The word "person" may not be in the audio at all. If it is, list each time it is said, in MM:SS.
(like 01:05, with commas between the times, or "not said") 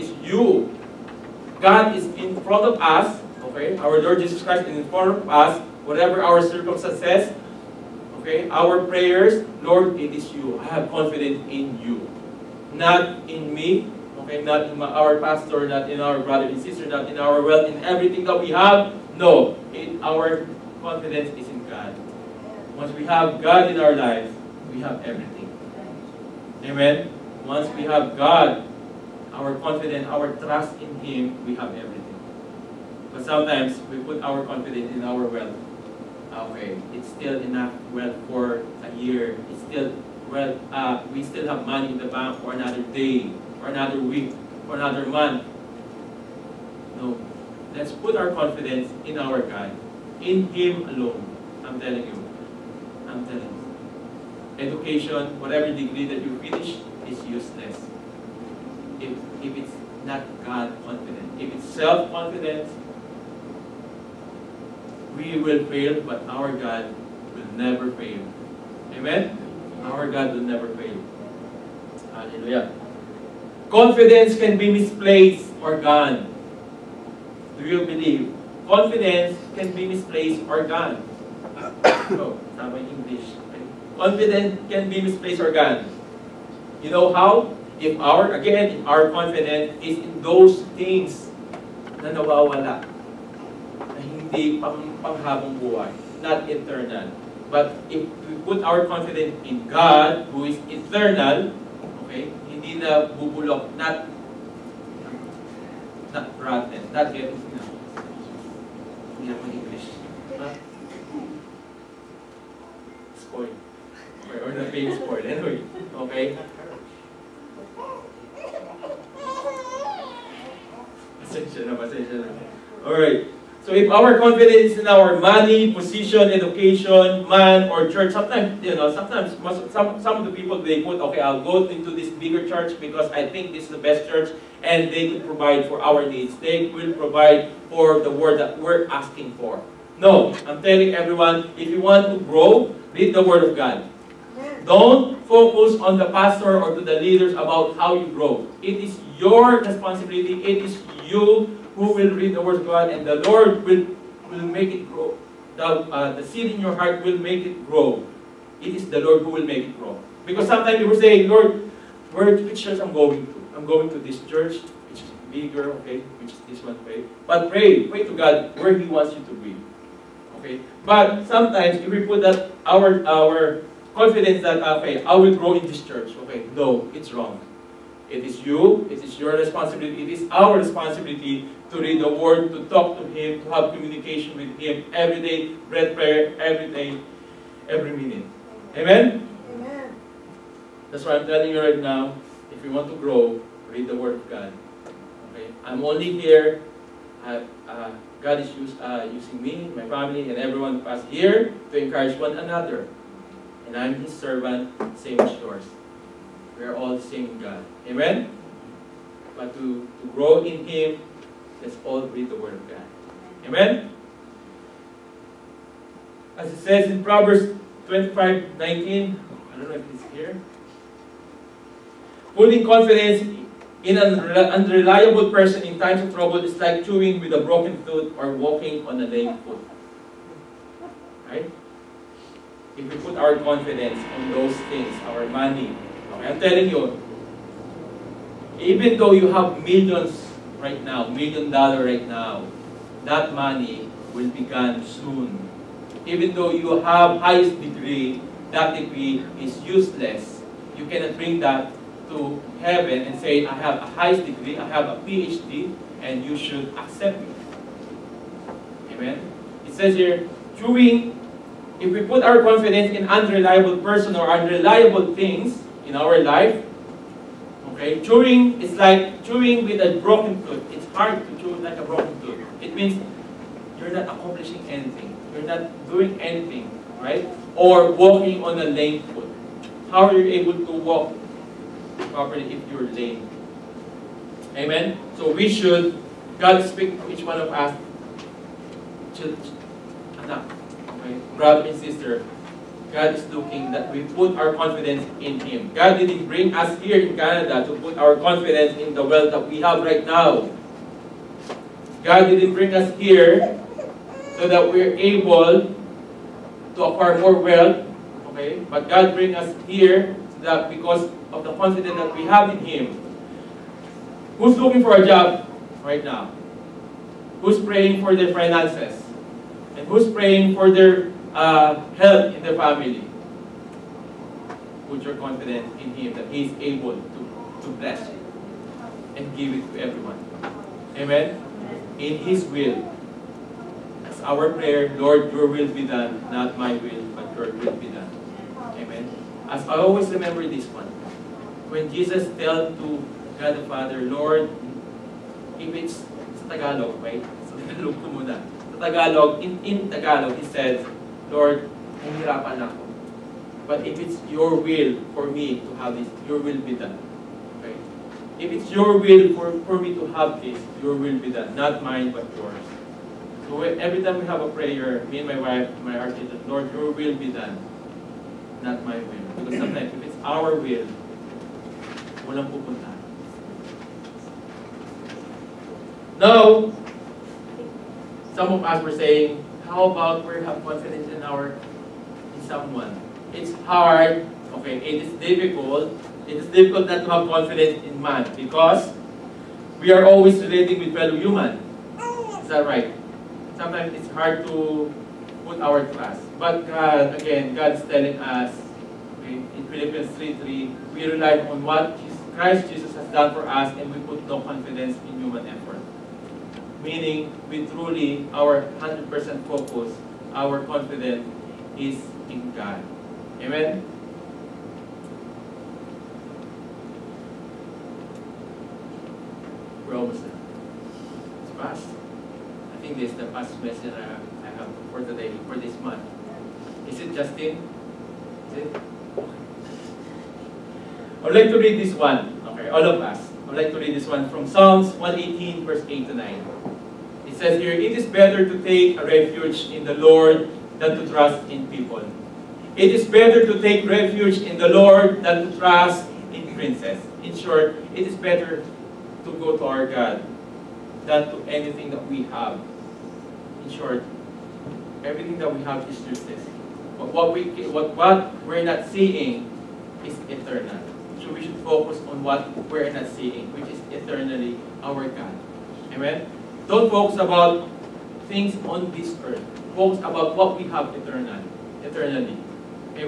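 03:45, 04:23.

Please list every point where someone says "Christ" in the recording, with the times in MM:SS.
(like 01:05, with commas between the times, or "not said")
00:04, 06:42.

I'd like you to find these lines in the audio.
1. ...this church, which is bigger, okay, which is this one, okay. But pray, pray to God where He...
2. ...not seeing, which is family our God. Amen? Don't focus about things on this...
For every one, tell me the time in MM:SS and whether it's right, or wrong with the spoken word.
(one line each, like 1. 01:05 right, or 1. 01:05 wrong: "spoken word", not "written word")
1. 02:43 right
2. 07:42 wrong: "eternally", not "family".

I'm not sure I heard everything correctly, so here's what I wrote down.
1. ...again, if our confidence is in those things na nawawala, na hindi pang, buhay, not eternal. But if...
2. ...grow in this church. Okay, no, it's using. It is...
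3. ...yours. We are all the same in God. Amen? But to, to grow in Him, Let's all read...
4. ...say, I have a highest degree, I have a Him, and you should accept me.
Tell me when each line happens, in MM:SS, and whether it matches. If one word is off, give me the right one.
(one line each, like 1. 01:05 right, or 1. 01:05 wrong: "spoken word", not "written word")
1. 01:28 right
2. 02:55 wrong: "wrong", not "using"
3. 03:25 right
4. 04:13 wrong: "PhD", not "Him".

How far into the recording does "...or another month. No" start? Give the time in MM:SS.
00:44.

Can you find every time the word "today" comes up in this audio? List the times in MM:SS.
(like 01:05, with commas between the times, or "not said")
07:05.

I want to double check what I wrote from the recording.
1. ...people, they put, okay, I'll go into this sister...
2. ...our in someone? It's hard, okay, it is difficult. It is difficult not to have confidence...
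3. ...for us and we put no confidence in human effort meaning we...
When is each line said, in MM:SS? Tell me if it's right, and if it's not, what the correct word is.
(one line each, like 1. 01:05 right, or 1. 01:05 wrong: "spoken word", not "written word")
1. 02:10 wrong: "bigger", not "sister"
2. 06:21 right
3. 06:43 right.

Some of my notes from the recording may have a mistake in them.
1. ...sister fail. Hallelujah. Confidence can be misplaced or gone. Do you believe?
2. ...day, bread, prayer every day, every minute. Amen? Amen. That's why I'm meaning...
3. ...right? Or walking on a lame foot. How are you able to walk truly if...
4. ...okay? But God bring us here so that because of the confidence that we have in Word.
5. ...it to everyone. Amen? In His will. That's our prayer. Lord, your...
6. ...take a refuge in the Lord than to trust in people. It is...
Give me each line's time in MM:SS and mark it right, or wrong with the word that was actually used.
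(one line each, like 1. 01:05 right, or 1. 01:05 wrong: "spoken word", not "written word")
1. 01:10 wrong: "never", not "sister"
2. 03:05 wrong: "telling", not "meaning"
3. 04:37 wrong: "properly", not "truly"
4. 05:08 wrong: "Him", not "Word"
5. 05:29 right
6. 07:18 right.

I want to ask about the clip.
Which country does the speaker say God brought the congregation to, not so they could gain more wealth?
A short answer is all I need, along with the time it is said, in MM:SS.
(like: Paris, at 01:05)
Canada, at 04:57.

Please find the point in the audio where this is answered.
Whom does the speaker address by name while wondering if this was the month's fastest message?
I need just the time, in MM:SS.
07:07.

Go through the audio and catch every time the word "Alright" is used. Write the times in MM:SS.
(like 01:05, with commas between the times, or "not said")
02:02.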